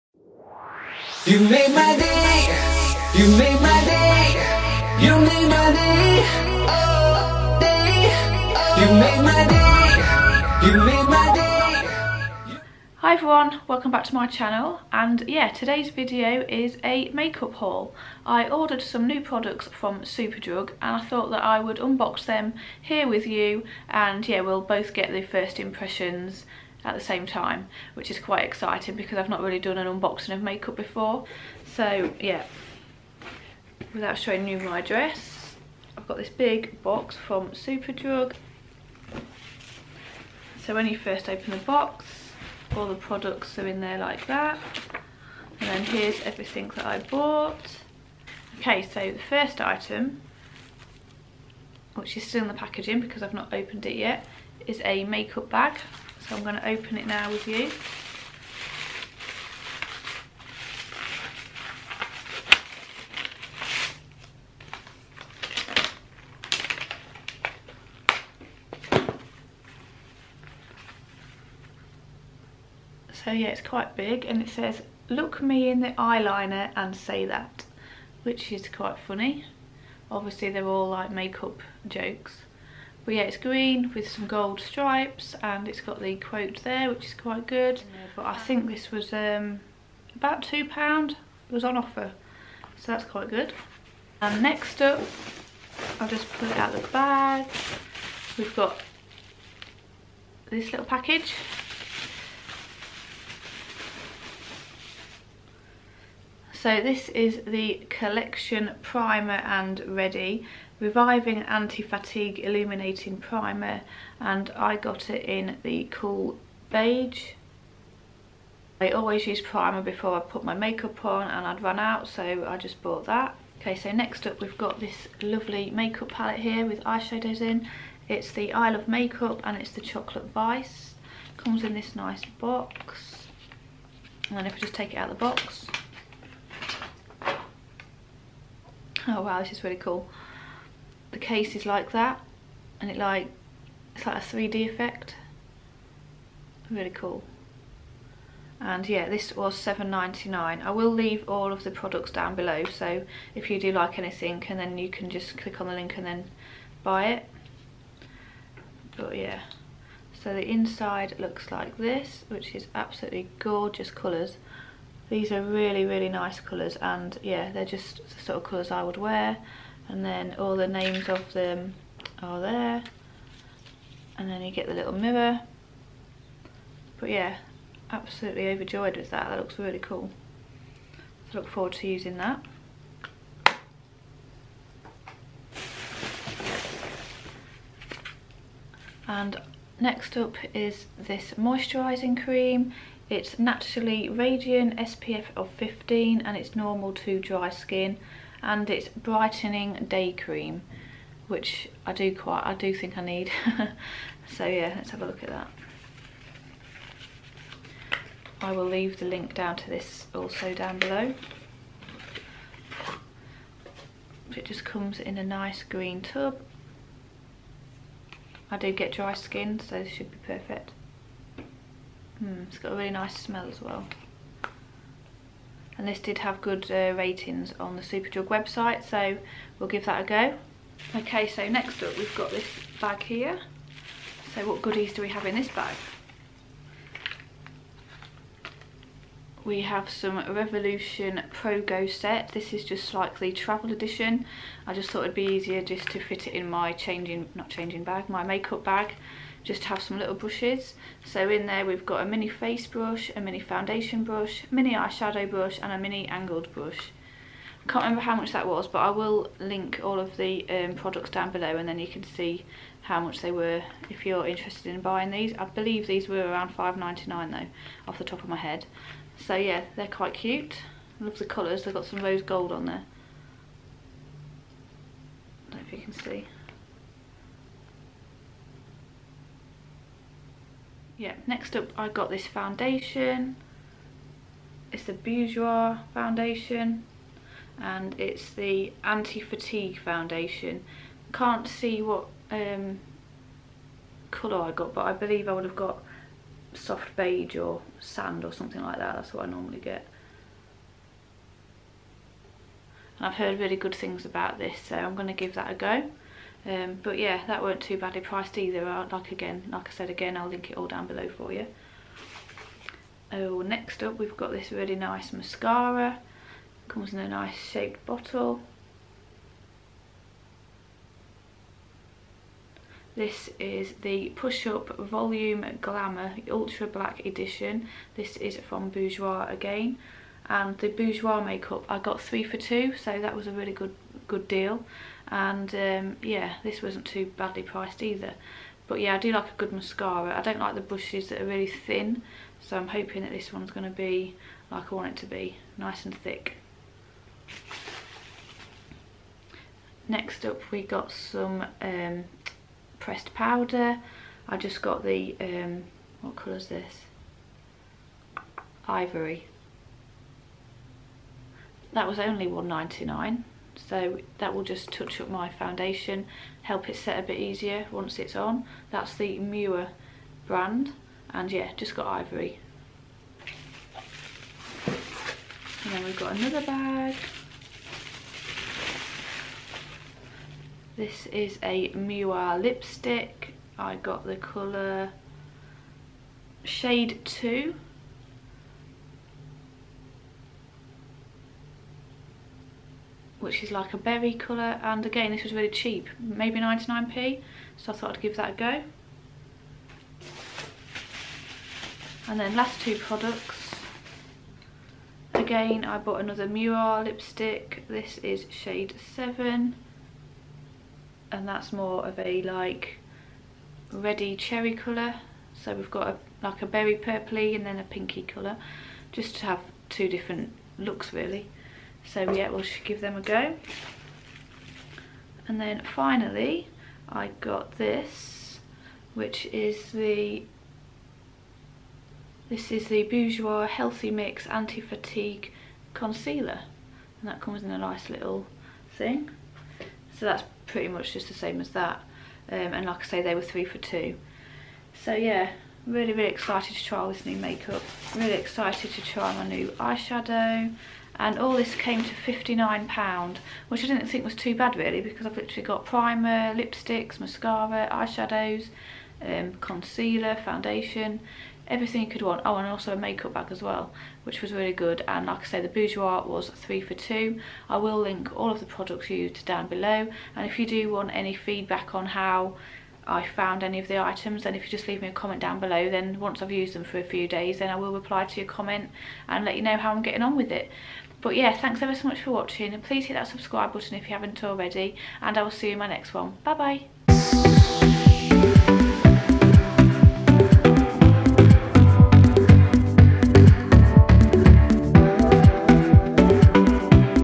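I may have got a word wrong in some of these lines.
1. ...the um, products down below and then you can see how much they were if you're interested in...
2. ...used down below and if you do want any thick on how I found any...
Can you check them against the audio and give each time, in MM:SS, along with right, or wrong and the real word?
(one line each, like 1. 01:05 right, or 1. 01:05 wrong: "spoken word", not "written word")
1. 04:20 right
2. 07:48 wrong: "feedback", not "thick".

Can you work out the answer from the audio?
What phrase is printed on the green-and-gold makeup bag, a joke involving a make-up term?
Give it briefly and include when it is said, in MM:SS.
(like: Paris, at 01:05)
Look me in the eyeliner and say that, at 01:15.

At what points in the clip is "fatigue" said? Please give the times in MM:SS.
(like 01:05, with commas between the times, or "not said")
01:51, 04:48, 07:14.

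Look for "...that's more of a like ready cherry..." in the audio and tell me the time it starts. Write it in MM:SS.
06:51.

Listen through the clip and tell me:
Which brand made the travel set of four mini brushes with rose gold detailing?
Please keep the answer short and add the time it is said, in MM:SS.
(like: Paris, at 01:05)
Revolution Pro, at 04:00.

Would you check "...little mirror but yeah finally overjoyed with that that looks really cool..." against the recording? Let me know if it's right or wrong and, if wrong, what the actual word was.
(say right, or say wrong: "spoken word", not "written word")
wrong: "absolutely", not "finally".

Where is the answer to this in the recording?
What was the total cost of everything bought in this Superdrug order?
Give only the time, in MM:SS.
07:31.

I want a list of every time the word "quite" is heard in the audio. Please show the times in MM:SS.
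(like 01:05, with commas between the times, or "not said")
00:28, 01:13, 01:18, 01:27, 01:33, 03:22, 04:29.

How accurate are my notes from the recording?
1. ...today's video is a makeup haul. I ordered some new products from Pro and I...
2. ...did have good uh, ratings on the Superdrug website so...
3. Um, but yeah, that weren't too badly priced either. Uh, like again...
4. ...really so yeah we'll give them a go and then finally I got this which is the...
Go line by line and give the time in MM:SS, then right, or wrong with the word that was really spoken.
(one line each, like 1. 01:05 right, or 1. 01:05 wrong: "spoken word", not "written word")
1. 00:15 wrong: "Superdrug", not "Pro"
2. 03:45 right
3. 05:06 right
4. 07:00 right.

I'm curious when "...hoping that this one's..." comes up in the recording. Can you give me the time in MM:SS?
05:42.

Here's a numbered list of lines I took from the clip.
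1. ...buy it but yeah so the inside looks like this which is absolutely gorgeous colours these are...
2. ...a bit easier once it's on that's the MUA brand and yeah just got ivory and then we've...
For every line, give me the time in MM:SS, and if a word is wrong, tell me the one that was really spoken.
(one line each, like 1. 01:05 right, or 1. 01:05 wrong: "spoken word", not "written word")
1. 02:36 right
2. 06:06 right.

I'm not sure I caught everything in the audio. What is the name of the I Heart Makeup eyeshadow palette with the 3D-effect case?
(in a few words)
Chocolate Vice.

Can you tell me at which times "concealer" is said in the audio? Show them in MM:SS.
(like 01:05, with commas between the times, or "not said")
07:15, 07:39.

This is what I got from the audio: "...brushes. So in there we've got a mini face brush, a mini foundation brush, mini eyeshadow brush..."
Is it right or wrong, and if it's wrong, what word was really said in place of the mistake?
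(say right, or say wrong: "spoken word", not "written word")
right.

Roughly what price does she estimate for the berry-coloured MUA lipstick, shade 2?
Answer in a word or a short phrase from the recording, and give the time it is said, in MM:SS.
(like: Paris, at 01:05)
99p, at 06:36.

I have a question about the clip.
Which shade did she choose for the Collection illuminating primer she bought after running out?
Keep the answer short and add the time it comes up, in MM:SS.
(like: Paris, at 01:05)
Cool beige, at 01:55.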